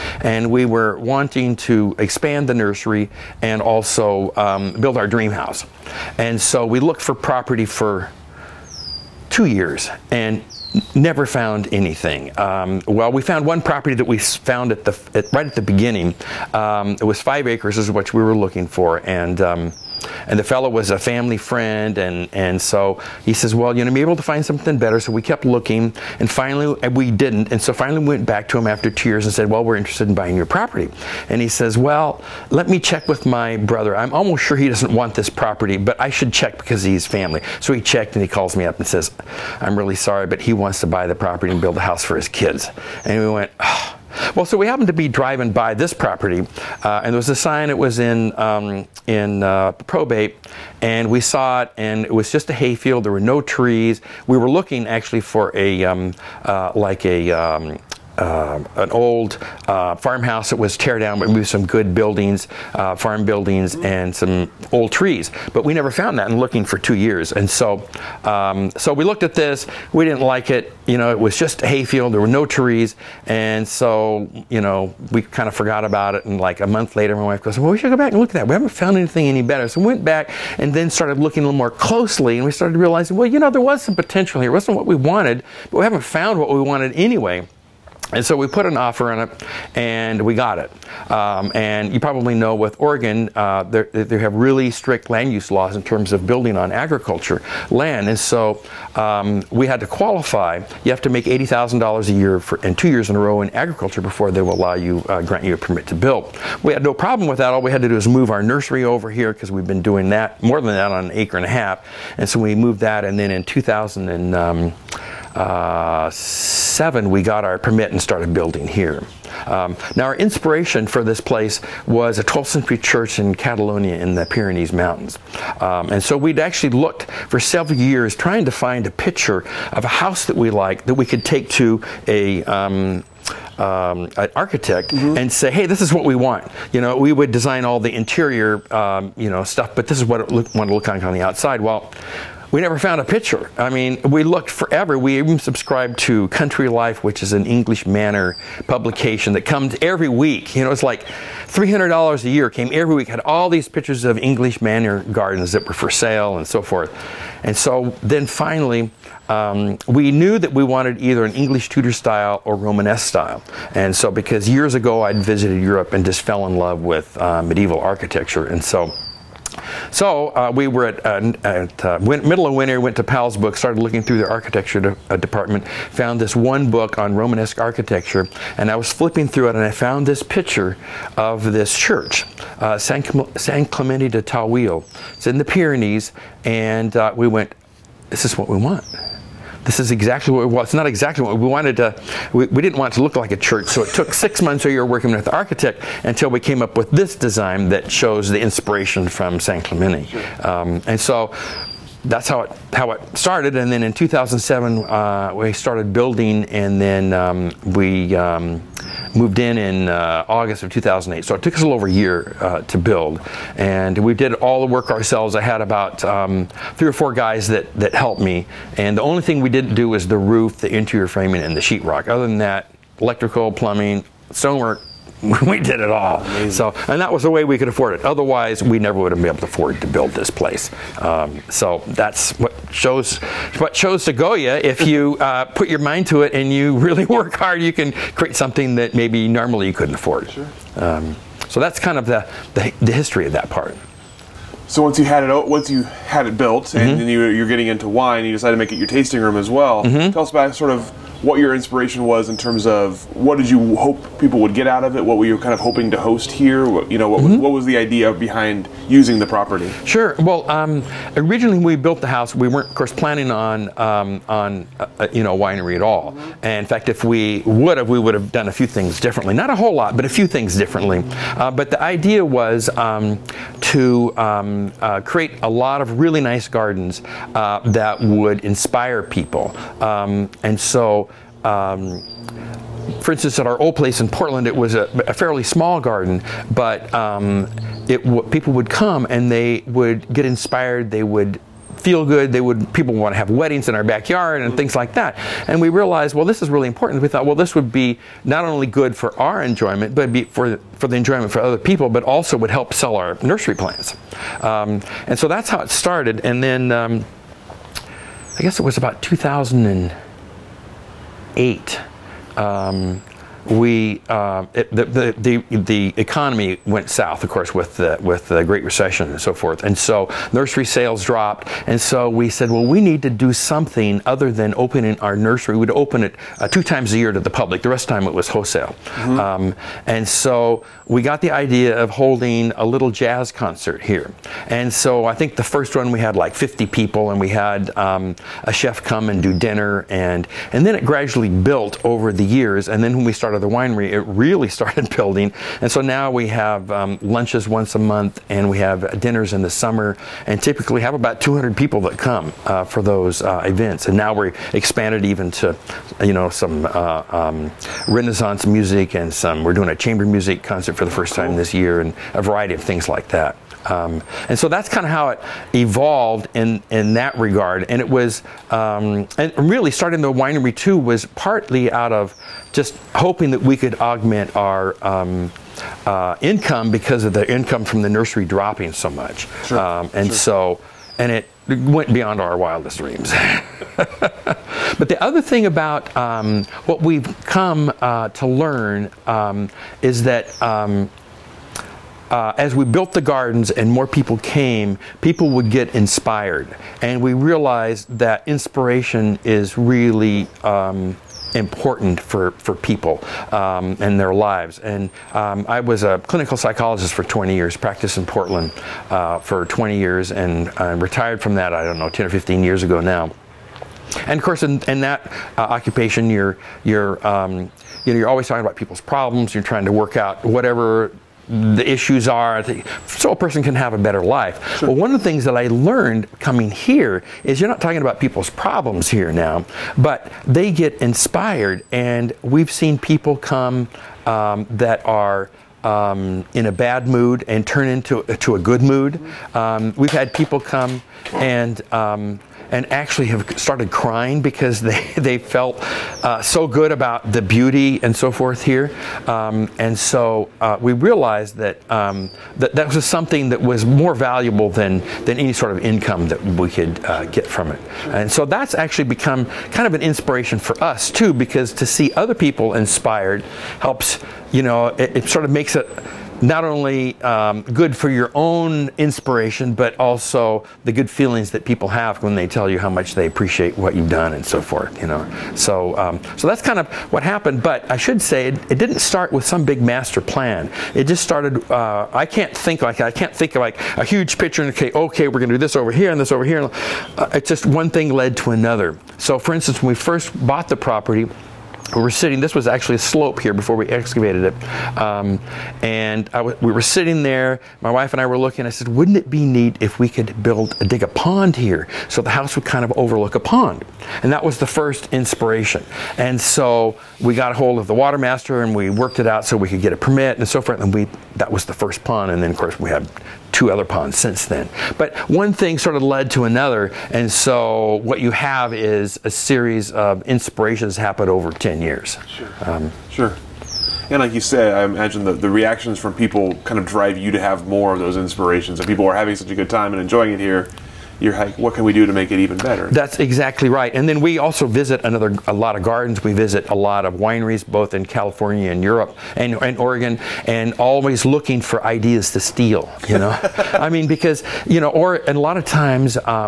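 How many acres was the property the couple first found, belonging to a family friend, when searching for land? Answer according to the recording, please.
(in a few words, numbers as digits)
5.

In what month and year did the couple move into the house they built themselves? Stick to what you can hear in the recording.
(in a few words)
August 2008.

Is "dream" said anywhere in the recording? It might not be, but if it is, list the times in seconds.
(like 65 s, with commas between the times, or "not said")
5 s, 382 s.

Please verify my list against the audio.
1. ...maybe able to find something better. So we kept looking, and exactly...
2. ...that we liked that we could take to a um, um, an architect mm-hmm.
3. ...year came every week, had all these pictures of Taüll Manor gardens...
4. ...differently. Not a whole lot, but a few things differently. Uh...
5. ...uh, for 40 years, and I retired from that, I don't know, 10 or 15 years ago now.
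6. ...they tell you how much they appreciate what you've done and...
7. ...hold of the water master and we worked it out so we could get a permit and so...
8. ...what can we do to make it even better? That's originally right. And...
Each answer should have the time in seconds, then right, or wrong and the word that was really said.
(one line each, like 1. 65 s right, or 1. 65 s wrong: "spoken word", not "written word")
1. 23 s wrong: "finally", not "exactly"
2. 130 s right
3. 152 s wrong: "English", not "Taüll"
4. 269 s right
5. 408 s wrong: "20", not "40"
6. 472 s right
7. 507 s right
8. 531 s wrong: "exactly", not "originally".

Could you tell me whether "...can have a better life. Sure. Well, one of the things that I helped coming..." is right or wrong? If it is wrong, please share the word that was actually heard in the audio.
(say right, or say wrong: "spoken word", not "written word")
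wrong: "learned", not "helped".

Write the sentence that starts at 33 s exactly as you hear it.
I'm almost sure he doesn't want this property, but I should check because he's family.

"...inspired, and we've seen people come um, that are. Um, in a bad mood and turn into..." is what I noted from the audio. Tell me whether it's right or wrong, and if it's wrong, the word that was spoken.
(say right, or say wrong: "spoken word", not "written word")
right.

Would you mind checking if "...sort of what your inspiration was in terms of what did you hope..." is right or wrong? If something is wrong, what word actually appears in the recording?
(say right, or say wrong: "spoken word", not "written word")
right.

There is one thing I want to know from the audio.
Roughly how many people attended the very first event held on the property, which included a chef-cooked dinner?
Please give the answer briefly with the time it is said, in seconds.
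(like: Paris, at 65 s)
50, at 336 s.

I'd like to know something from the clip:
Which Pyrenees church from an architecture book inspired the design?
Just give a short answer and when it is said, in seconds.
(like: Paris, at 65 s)
San Clemente de Taüll, at 183 s.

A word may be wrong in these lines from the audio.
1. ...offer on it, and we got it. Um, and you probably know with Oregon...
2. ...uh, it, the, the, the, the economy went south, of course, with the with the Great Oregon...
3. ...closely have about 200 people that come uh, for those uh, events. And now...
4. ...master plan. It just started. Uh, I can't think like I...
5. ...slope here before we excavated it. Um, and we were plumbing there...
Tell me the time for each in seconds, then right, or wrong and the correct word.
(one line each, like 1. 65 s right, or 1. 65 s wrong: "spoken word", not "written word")
1. 88 s right
2. 314 s wrong: "Recession", not "Oregon"
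3. 350 s wrong: "typically", not "closely"
4. 479 s right
5. 492 s wrong: "sitting", not "plumbing".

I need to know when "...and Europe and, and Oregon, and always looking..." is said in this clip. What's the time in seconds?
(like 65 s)
538 s.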